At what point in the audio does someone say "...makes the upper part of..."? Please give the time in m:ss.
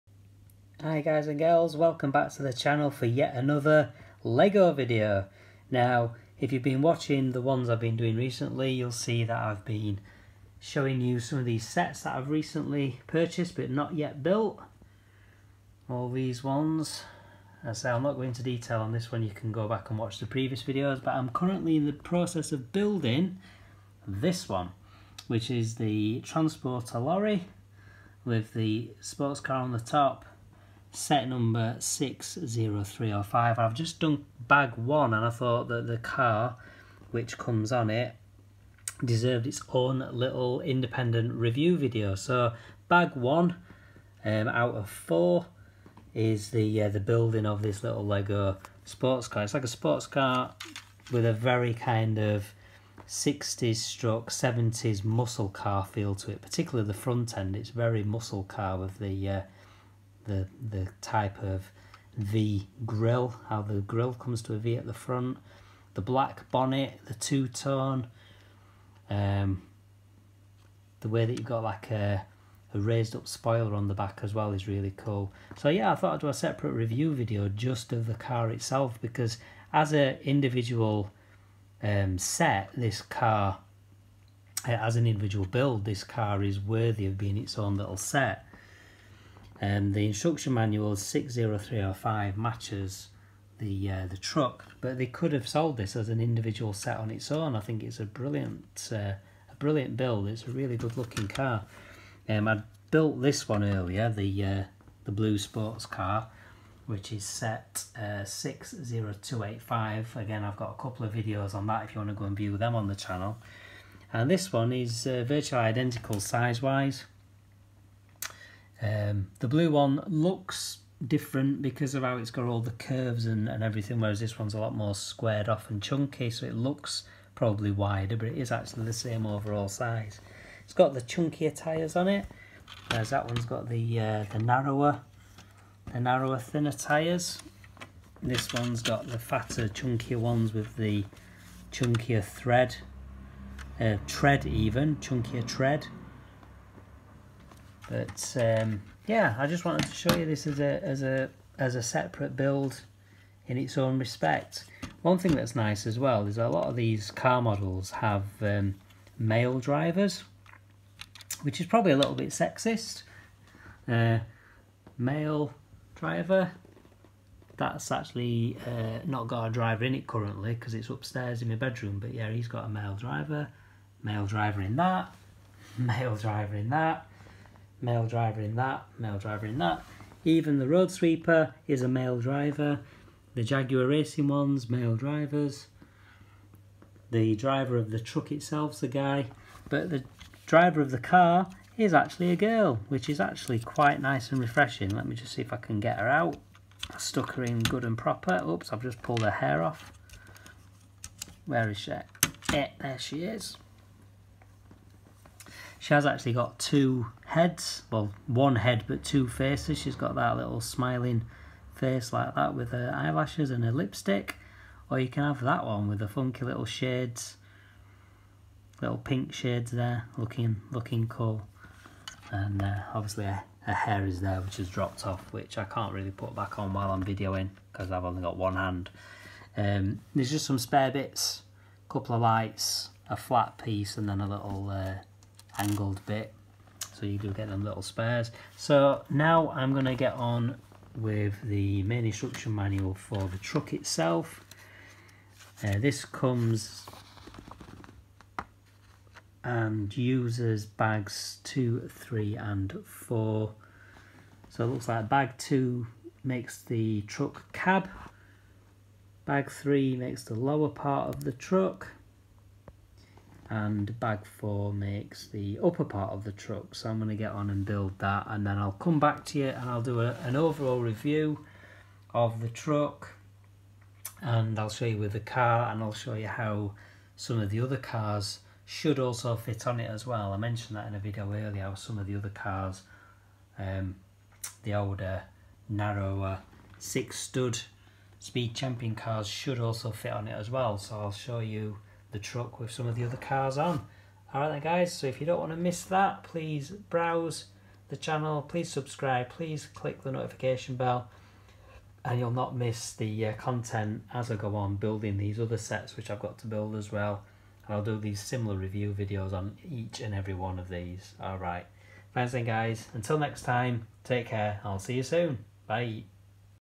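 4:24.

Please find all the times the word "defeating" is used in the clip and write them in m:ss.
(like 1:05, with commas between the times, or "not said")
not said.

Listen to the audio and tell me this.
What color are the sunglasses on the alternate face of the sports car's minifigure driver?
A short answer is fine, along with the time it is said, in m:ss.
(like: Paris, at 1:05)
Pink, at 3:38.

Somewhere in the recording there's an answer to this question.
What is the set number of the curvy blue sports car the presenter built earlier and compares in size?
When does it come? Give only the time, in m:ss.
1:48.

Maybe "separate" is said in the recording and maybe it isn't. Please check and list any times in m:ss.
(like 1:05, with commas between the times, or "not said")
1:16, 2:31.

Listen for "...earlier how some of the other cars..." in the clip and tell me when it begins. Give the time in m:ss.
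4:41.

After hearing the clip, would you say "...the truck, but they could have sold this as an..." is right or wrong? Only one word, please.
right.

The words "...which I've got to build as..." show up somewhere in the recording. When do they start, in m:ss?
5:05.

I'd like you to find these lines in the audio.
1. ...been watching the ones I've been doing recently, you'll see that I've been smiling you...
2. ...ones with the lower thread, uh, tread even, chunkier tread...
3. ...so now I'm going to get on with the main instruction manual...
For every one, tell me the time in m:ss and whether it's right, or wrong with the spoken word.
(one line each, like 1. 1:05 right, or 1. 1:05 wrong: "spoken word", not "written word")
1. 0:06 wrong: "showing", not "smiling"
2. 2:20 wrong: "chunkier", not "lower"
3. 3:58 right.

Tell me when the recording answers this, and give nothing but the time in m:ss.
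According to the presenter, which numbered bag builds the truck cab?
4:15.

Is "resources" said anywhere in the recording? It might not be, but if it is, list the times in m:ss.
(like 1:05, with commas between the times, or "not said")
not said.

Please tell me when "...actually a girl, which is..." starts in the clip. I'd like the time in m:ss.
3:11.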